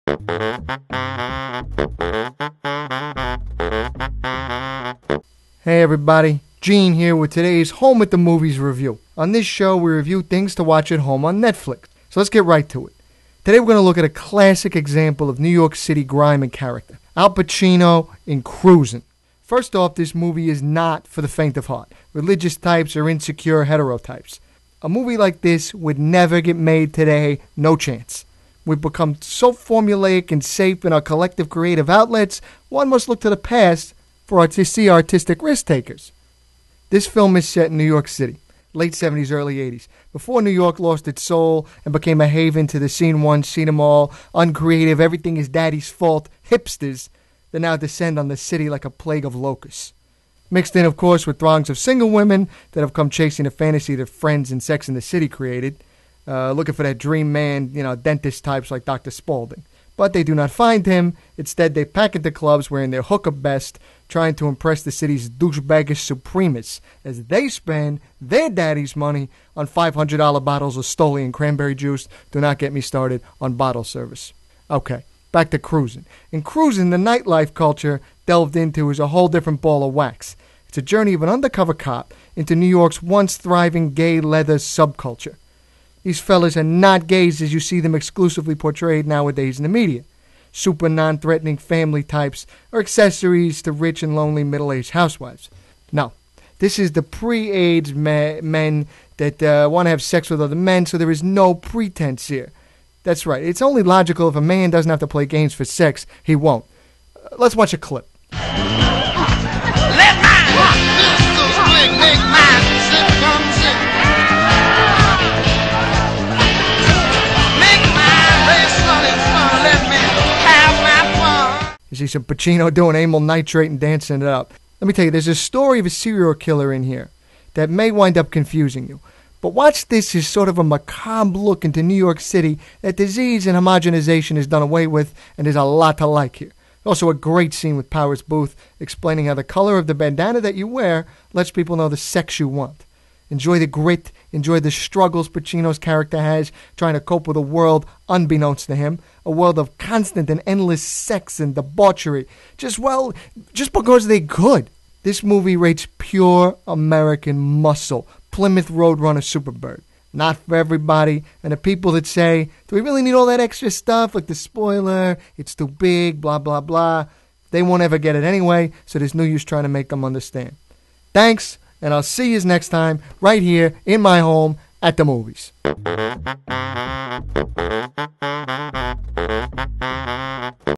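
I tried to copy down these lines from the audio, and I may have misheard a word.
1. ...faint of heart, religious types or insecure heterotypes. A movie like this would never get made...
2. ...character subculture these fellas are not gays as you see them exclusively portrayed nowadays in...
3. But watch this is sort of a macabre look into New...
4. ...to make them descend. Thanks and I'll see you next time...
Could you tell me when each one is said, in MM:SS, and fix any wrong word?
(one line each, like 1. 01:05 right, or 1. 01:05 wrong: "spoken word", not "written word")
1. 00:21 right
2. 01:24 wrong: "leather", not "character"
3. 02:09 right
4. 02:49 wrong: "understand", not "descend".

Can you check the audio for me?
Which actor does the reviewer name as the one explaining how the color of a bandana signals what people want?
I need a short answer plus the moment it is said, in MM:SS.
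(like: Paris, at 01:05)
Powers Boothe, at 02:17.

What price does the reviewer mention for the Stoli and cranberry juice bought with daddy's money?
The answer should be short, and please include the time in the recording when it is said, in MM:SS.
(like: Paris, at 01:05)
$500, at 01:09.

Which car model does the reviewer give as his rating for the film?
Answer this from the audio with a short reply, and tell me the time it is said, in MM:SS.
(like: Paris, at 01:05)
Plymouth Roadrunner Superbird, at 02:38.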